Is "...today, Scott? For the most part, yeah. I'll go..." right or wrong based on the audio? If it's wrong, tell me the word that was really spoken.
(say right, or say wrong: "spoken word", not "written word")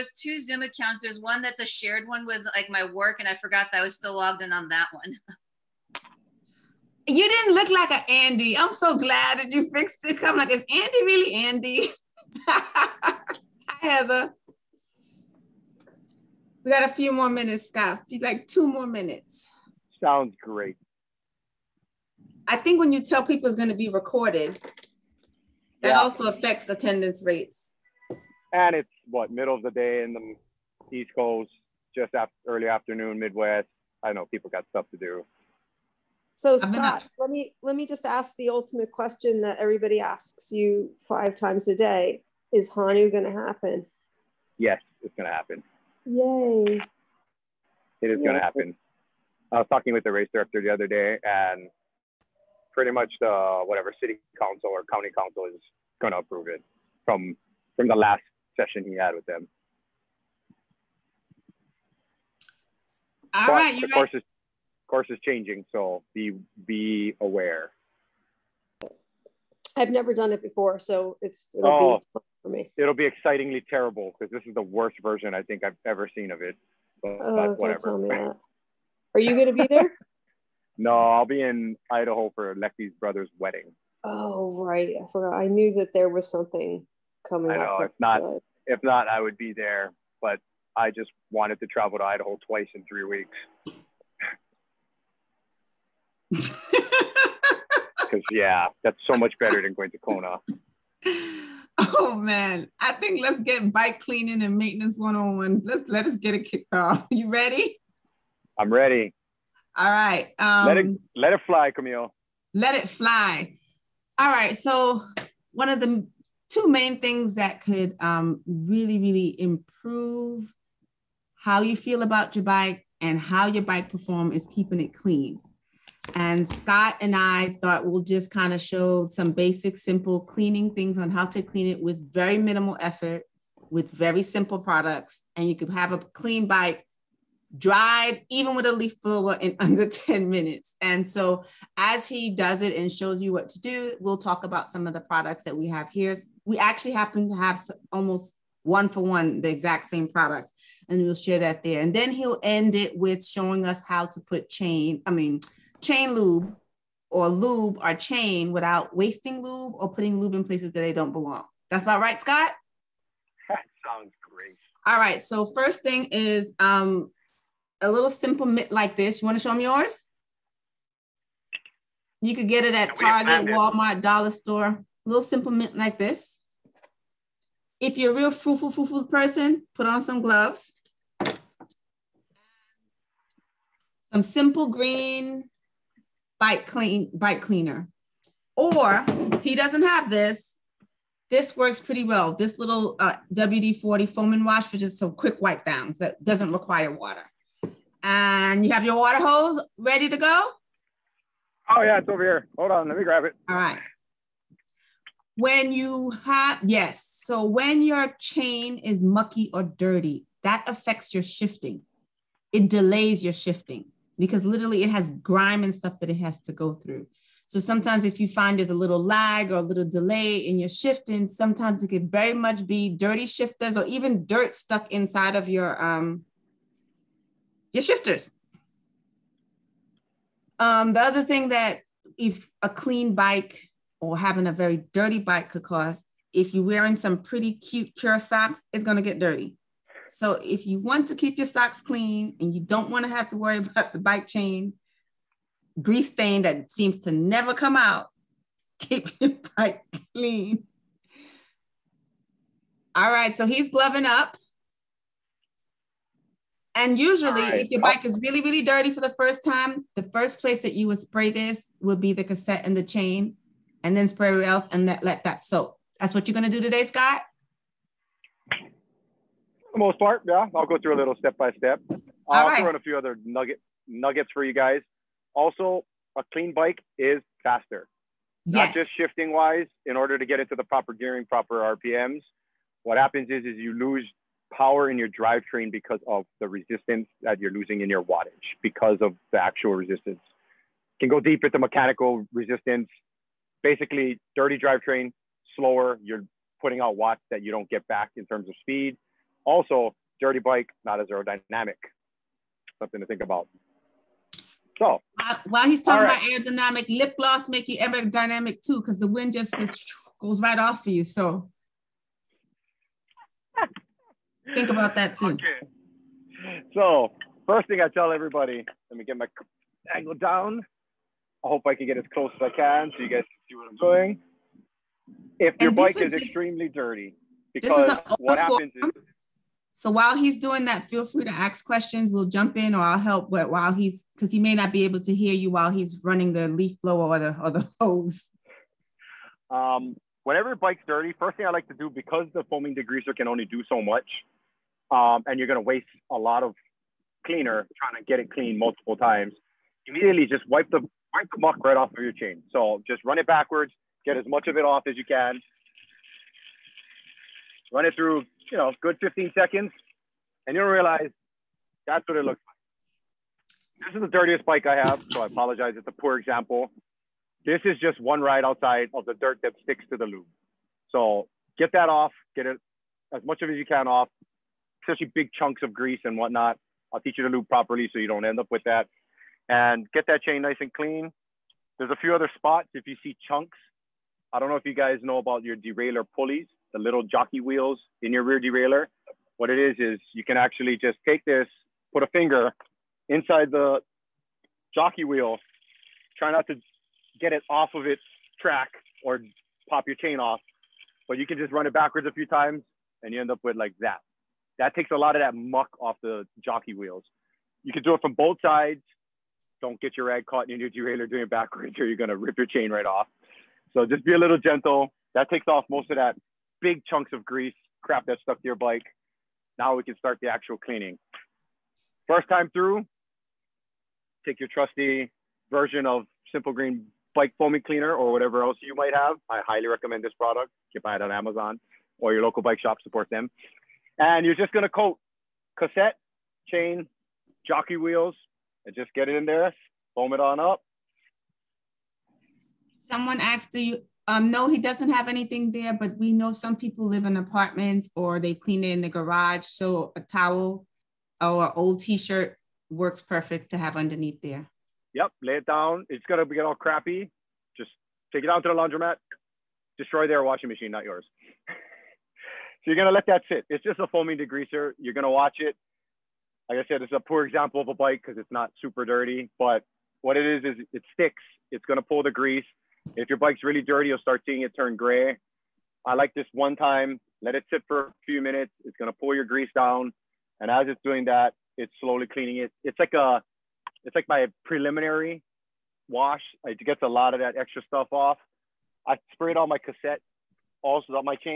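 right.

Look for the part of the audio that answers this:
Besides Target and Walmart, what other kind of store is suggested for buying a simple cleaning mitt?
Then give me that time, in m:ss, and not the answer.
2:54.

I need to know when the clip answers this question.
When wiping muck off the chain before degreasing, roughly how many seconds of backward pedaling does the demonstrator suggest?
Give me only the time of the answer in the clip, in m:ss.
5:58.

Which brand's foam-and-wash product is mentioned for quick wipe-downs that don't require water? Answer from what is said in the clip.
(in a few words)
WD-40.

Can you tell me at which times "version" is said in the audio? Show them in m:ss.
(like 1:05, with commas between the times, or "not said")
1:15, 7:05.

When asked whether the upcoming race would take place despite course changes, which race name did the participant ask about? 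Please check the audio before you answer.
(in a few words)
Honu.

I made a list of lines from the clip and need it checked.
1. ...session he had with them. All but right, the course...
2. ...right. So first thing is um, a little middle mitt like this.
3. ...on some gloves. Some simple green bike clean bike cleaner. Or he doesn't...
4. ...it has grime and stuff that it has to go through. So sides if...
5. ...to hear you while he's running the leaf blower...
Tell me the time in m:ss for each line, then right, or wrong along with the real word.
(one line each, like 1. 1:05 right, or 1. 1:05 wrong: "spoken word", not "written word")
1. 0:58 right
2. 2:44 wrong: "simple", not "middle"
3. 2:59 right
4. 3:34 wrong: "sometimes", not "sides"
5. 5:34 right.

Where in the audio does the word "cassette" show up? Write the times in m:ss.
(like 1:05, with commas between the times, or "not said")
4:22, 7:15, 8:09.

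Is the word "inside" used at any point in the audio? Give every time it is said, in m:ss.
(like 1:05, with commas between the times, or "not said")
3:44, 6:33.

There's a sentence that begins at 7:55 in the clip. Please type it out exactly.
I like this one time, let it sit for a few minutes.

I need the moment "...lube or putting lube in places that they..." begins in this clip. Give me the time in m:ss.
2:39.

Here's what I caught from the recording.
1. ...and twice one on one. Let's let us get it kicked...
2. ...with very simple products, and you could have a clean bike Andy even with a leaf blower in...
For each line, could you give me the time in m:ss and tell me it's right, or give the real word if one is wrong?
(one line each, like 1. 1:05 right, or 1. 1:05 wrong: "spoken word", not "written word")
1. 1:44 wrong: "maintenance", not "twice"
2. 2:13 wrong: "Dried", not "Andy".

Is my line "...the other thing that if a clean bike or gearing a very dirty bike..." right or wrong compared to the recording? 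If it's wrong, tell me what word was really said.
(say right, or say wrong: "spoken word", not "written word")
wrong: "having", not "gearing".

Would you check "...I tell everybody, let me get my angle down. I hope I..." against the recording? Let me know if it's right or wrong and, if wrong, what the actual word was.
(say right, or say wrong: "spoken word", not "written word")
right.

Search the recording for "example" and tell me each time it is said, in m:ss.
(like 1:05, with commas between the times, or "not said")
6:06, 7:47.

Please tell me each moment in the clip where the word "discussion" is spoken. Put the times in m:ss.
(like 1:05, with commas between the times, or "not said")
not said.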